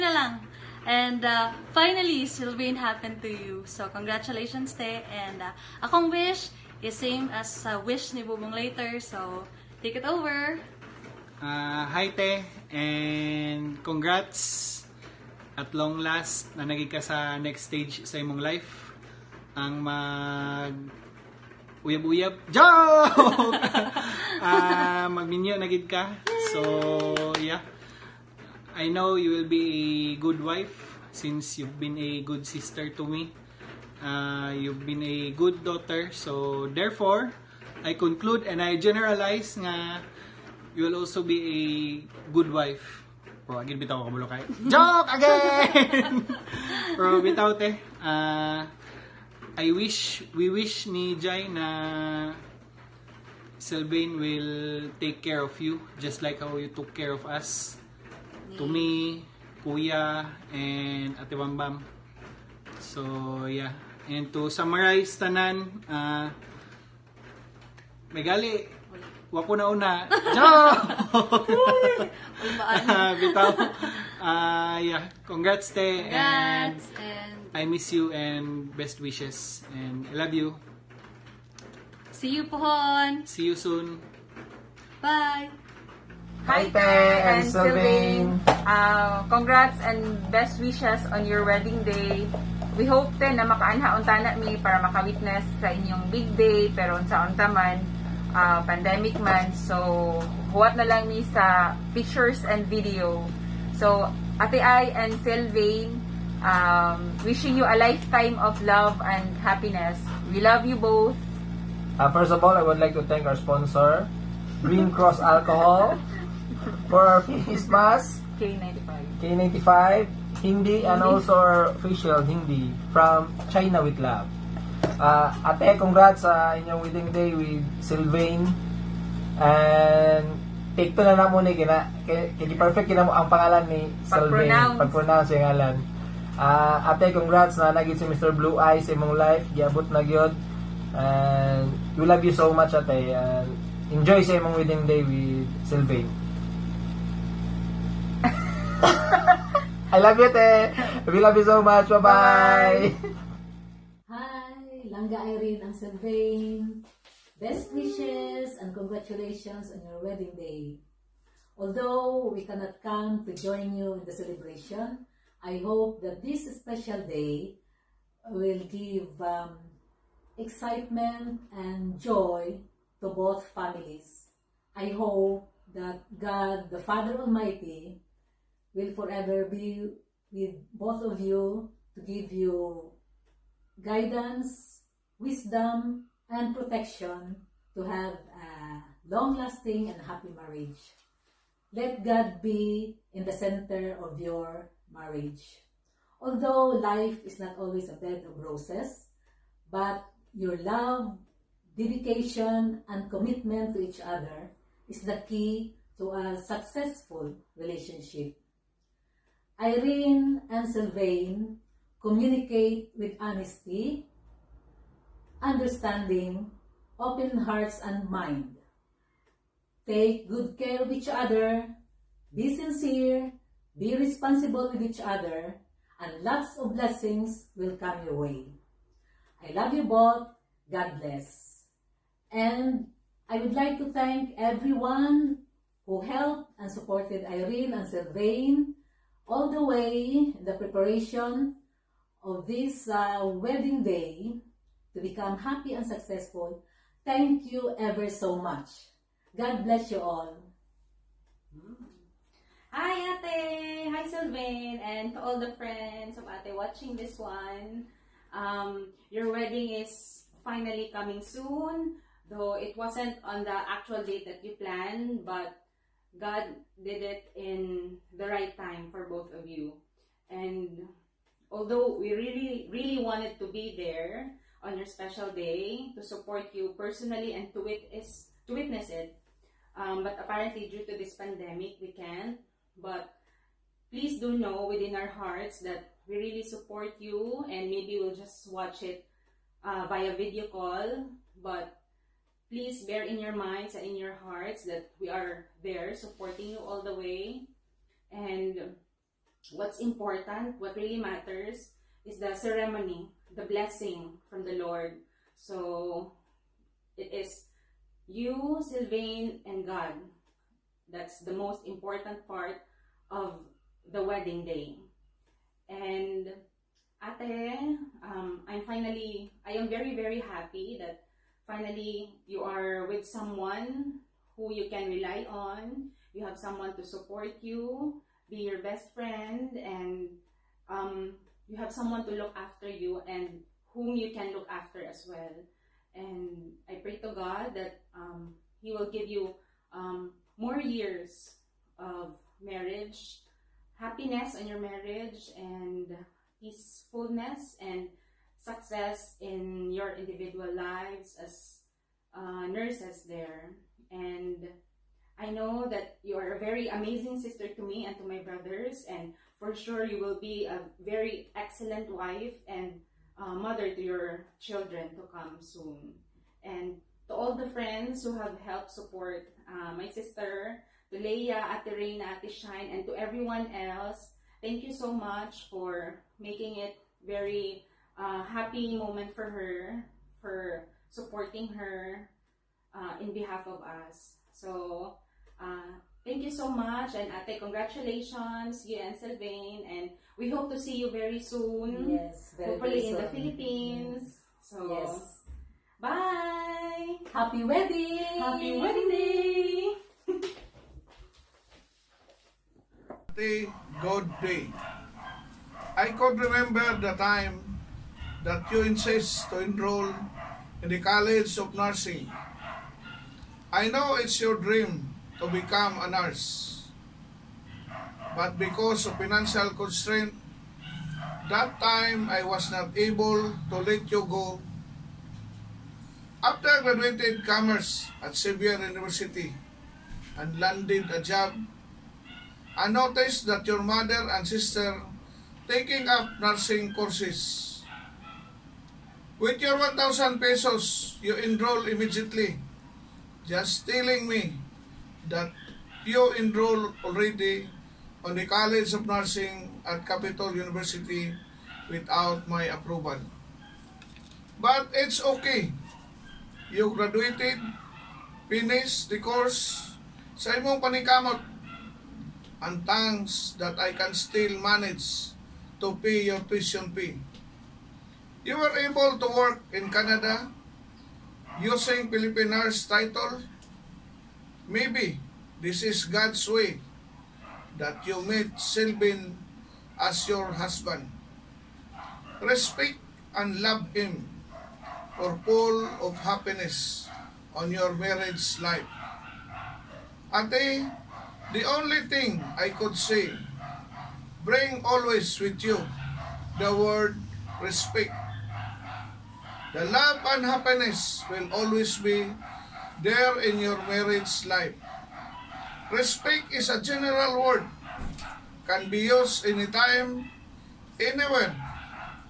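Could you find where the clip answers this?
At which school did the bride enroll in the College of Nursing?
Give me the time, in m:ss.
7:29.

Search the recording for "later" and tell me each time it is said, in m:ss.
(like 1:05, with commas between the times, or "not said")
0:08.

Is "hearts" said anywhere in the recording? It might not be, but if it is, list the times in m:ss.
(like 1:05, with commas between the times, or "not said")
3:37, 4:45, 4:54.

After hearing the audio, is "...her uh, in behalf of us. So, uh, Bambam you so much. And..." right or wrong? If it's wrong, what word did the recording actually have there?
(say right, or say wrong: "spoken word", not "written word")
wrong: "Thank", not "Bambam".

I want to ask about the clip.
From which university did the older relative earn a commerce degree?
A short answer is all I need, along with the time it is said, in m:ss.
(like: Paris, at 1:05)
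Xavier University, at 7:08.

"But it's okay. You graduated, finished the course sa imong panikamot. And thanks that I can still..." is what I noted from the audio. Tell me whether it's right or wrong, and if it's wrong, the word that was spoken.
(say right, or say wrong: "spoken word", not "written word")
right.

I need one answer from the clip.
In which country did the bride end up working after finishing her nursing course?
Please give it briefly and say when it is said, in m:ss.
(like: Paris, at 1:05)
Canada, at 7:49.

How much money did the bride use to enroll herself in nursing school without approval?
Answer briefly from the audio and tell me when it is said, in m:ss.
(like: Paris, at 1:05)
1,000 pesos, at 7:19.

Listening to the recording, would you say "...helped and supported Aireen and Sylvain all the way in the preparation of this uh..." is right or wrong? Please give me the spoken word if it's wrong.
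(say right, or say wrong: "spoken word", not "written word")
right.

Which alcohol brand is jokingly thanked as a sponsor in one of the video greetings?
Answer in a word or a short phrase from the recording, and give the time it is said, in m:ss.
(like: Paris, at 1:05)
Green Cross, at 1:54.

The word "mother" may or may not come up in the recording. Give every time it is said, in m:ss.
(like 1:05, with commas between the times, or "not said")
6:03, 7:13.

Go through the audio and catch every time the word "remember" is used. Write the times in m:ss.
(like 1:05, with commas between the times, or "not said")
6:46.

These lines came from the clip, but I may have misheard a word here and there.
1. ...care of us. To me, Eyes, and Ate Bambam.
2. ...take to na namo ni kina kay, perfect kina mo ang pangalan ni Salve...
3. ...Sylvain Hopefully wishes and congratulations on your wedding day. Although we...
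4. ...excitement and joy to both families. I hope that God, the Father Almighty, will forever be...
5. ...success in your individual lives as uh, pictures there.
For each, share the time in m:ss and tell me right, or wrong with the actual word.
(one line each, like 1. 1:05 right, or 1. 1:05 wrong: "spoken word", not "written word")
1. 0:56 wrong: "Kuya", not "Eyes"
2. 2:10 right
3. 2:35 wrong: "Best", not "Hopefully"
4. 2:50 right
5. 5:48 wrong: "nurses", not "pictures".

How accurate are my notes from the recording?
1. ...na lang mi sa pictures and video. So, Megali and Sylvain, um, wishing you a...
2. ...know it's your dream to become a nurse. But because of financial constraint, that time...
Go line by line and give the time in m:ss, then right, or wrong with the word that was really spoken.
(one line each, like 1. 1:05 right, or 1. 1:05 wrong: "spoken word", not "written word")
1. 1:40 wrong: "Ate", not "Megali"
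2. 6:53 right.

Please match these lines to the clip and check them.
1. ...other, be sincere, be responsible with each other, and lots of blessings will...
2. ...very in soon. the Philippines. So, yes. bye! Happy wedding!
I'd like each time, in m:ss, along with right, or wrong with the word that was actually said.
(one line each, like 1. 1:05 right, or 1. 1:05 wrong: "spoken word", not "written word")
1. 3:41 right
2. 6:32 right.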